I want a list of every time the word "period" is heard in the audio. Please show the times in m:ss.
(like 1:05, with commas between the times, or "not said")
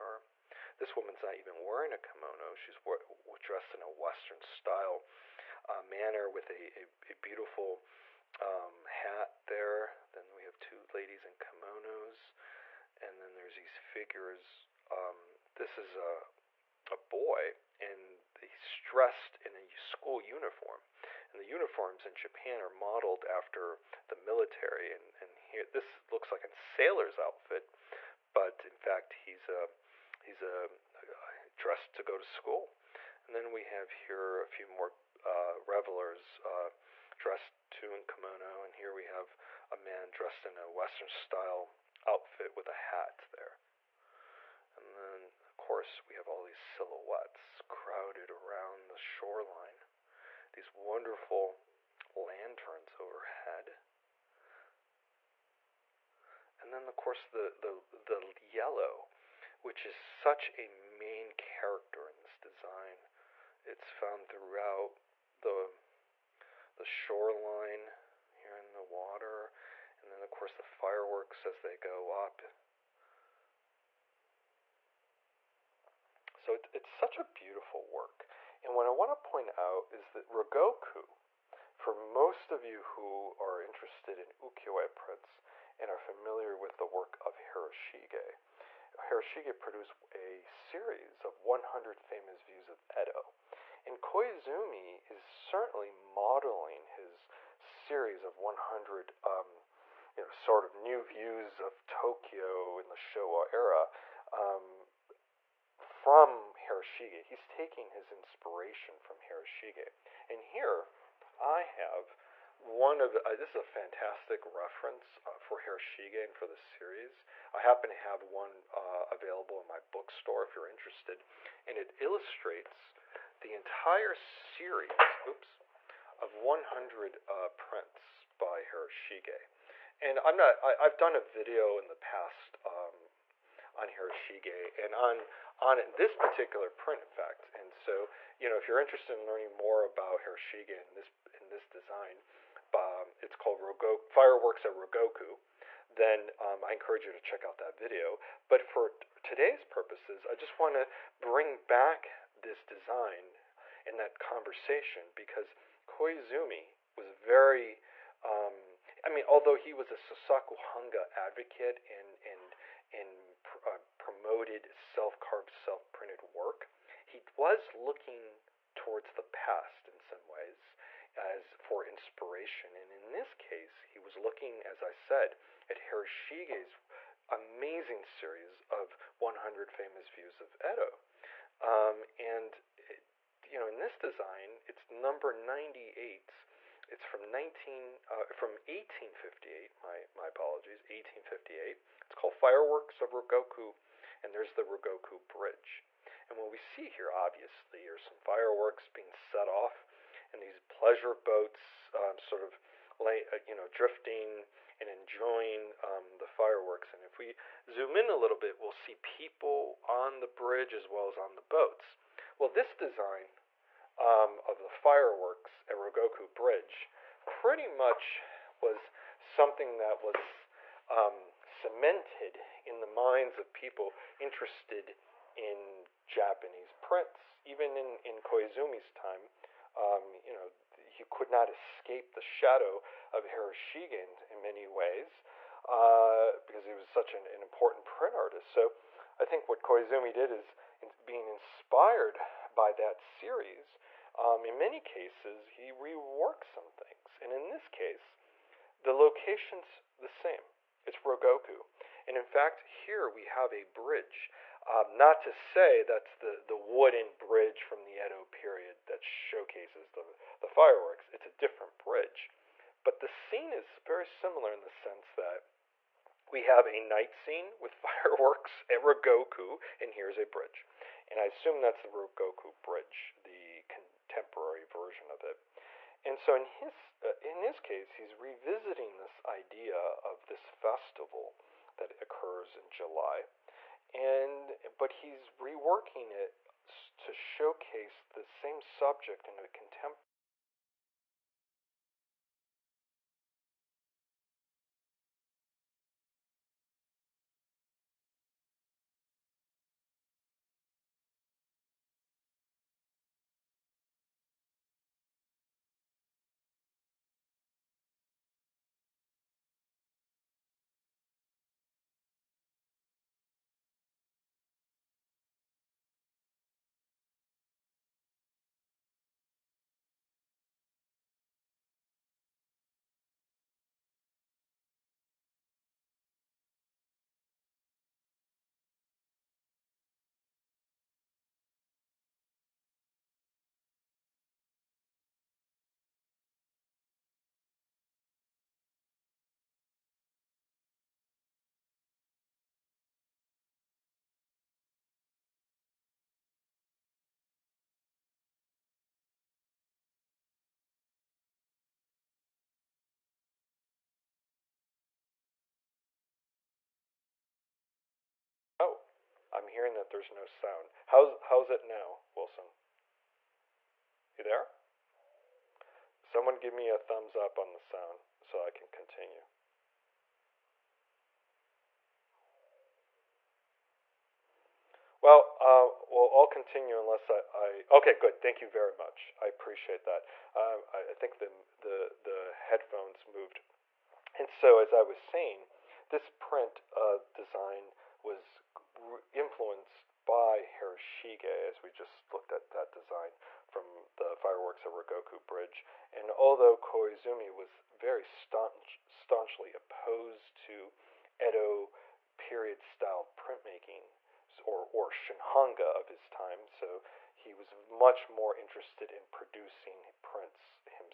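4:18, 6:42.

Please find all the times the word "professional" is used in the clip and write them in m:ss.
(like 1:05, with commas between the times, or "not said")
not said.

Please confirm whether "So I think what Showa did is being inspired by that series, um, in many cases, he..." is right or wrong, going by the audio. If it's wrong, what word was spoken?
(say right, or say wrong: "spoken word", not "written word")
wrong: "Koizumi", not "Showa".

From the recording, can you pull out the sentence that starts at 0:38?
And here we have a man dressed in a Western style outfit with a hat there.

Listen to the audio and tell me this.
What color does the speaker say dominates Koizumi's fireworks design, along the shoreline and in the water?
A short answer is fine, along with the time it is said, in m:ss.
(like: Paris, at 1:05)
Yellow, at 0:58.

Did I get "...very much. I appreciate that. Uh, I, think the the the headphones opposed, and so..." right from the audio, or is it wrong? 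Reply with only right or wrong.
wrong.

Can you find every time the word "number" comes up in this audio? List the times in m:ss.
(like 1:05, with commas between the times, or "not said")
3:04.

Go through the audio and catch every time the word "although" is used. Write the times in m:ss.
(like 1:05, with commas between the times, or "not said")
2:39, 6:36.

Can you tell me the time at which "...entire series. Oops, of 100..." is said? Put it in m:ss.
2:03.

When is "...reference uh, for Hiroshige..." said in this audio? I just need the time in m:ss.
1:54.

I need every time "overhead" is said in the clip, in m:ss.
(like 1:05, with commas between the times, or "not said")
0:52.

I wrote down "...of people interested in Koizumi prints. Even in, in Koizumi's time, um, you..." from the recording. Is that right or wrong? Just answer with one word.
wrong.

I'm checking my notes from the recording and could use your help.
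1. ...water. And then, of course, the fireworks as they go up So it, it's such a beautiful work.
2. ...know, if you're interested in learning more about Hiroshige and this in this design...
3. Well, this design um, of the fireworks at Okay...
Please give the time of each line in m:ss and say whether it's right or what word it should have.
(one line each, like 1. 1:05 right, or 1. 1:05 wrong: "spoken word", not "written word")
1. 1:08 right
2. 2:18 right
3. 3:32 wrong: "Ryogoku", not "Okay".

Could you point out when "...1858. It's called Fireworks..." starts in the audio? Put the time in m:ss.
3:10.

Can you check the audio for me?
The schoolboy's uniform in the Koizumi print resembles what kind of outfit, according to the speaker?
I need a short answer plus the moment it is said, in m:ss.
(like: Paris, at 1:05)
A sailor's outfit, at 0:26.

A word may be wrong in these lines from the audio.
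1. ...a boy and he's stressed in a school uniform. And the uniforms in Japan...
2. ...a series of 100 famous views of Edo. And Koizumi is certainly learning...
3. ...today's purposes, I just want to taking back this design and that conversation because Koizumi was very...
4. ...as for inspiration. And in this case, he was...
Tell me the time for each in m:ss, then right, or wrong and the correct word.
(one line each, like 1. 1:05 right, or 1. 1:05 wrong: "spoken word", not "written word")
1. 0:16 right
2. 1:30 wrong: "modeling", not "learning"
3. 2:29 wrong: "bring", not "taking"
4. 2:51 right.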